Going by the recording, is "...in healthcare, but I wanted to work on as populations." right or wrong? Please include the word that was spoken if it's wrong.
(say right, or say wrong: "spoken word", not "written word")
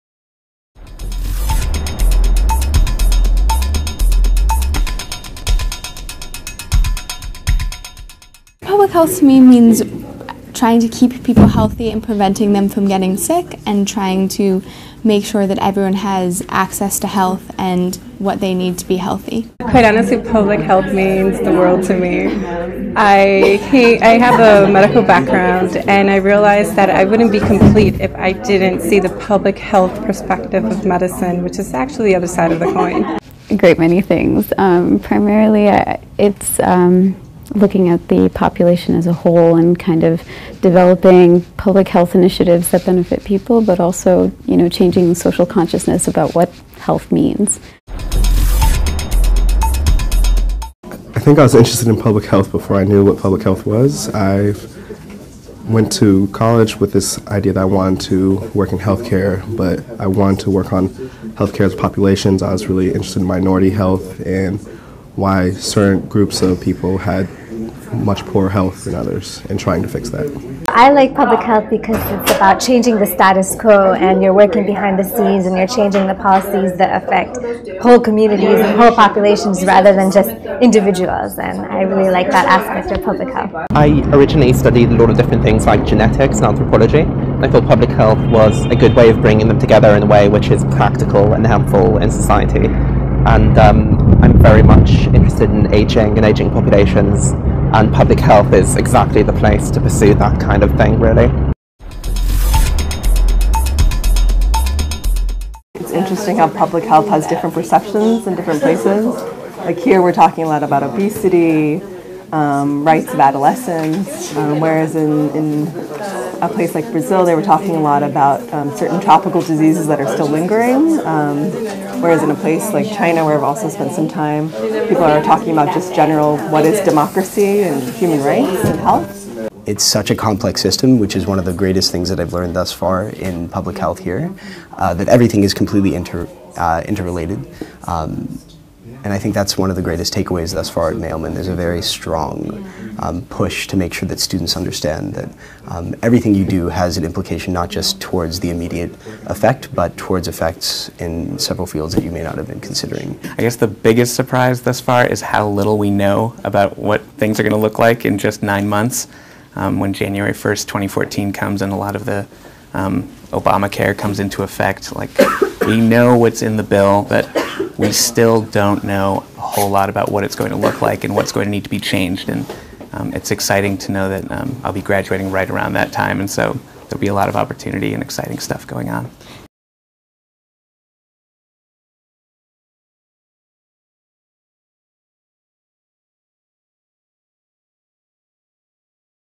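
right.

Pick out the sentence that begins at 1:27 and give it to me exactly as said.
I thought public health was a good way of bringing them together in a way which is practical and helpful in society.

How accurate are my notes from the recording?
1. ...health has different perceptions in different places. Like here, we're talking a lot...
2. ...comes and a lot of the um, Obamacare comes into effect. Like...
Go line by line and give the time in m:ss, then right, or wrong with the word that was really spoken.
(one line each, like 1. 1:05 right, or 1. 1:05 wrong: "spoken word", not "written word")
1. 1:46 right
2. 2:41 right.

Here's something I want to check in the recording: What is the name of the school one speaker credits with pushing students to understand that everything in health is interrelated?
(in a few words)
Mailman.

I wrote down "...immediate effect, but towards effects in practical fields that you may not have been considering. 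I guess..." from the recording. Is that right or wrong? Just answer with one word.
wrong.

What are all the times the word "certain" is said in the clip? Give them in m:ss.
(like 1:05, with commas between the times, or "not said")
1:05, 1:58.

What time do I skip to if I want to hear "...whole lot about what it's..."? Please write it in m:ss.
2:49.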